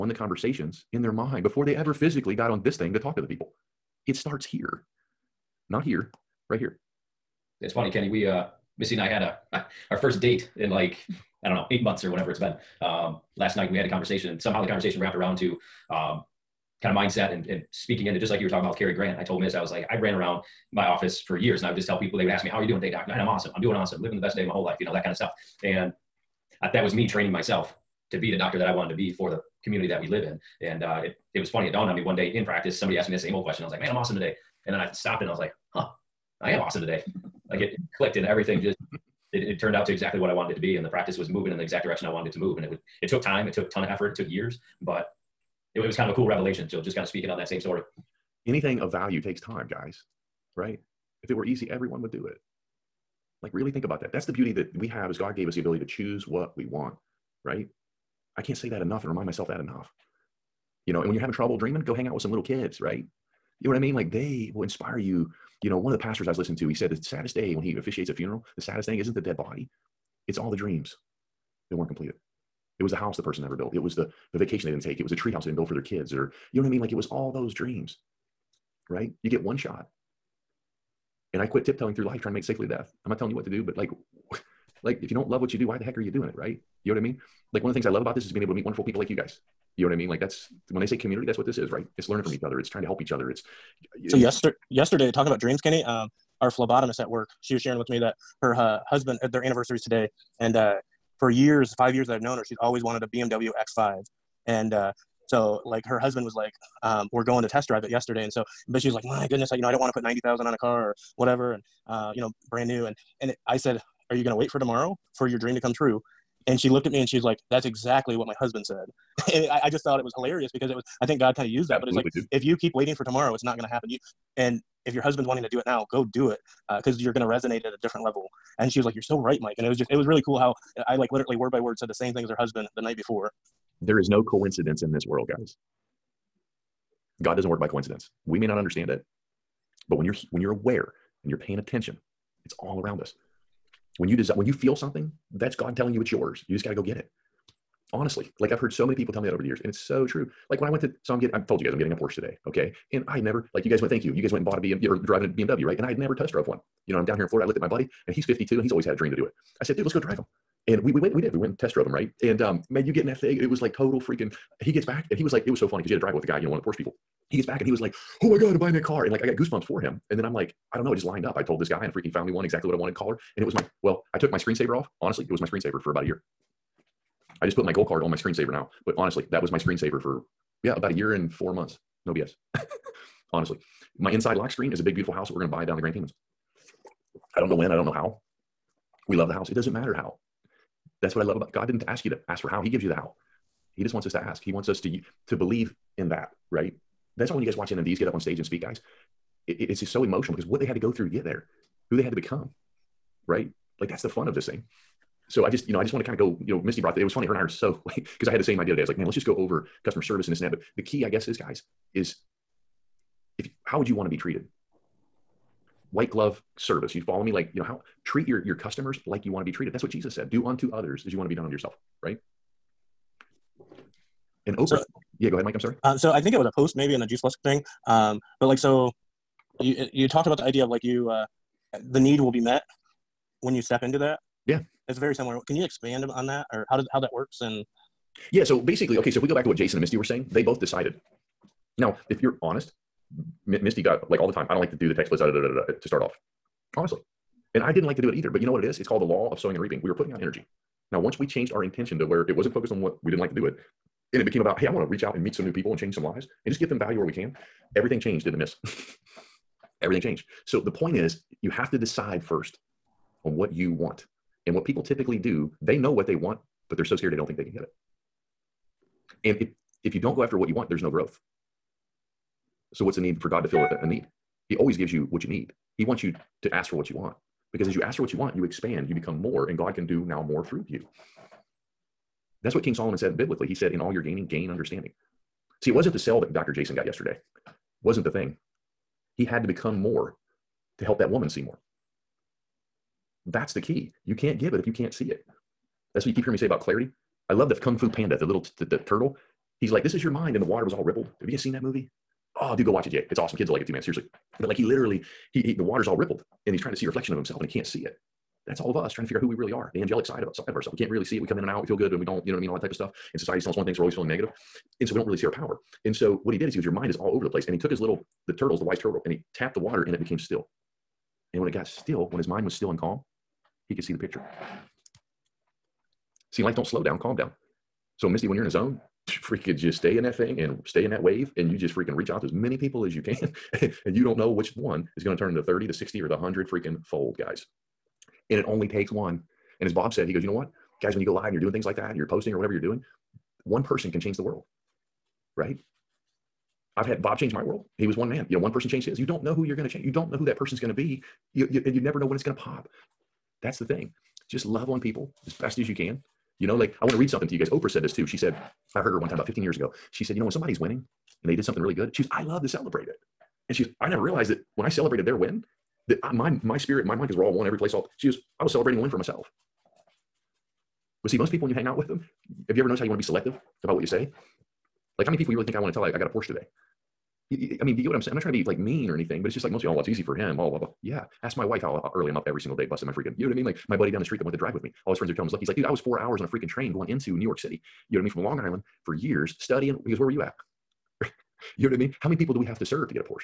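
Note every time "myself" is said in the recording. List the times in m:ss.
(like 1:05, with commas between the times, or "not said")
0:27, 0:59, 6:08.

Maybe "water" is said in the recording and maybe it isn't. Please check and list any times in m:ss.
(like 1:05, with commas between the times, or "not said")
5:00, 5:05, 5:19.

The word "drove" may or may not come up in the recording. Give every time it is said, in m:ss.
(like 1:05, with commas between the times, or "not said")
2:36, 2:41.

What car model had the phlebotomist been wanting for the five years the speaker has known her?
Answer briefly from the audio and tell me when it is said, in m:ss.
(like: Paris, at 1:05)
BMW X5, at 1:43.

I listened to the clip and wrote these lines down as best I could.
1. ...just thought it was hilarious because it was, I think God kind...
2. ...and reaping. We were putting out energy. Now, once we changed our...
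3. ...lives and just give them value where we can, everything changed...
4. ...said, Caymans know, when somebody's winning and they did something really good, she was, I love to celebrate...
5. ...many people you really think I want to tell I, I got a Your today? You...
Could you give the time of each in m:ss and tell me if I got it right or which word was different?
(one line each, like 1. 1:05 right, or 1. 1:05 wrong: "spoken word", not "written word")
1. 1:59 right
2. 4:09 right
3. 4:16 right
4. 6:00 wrong: "You", not "Caymans"
5. 6:15 wrong: "Porsche", not "Your".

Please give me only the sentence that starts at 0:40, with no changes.
And the practice was moving in the exact direction I wanted it to move.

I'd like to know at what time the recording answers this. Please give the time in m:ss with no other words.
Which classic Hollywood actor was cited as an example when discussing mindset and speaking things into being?
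0:18.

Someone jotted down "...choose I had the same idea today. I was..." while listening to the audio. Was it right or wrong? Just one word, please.
wrong.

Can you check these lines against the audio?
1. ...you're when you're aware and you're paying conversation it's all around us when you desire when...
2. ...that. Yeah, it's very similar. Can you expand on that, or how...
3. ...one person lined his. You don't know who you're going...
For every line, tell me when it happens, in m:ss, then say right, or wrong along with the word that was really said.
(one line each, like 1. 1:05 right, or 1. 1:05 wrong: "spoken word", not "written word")
1. 2:20 wrong: "attention", not "conversation"
2. 3:53 right
3. 5:48 wrong: "changed", not "lined".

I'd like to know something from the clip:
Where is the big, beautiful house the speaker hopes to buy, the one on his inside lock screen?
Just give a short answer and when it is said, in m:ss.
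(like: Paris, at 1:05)
Grand Caymans, at 3:05.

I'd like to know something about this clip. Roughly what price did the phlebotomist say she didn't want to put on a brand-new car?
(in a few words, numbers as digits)
90,000.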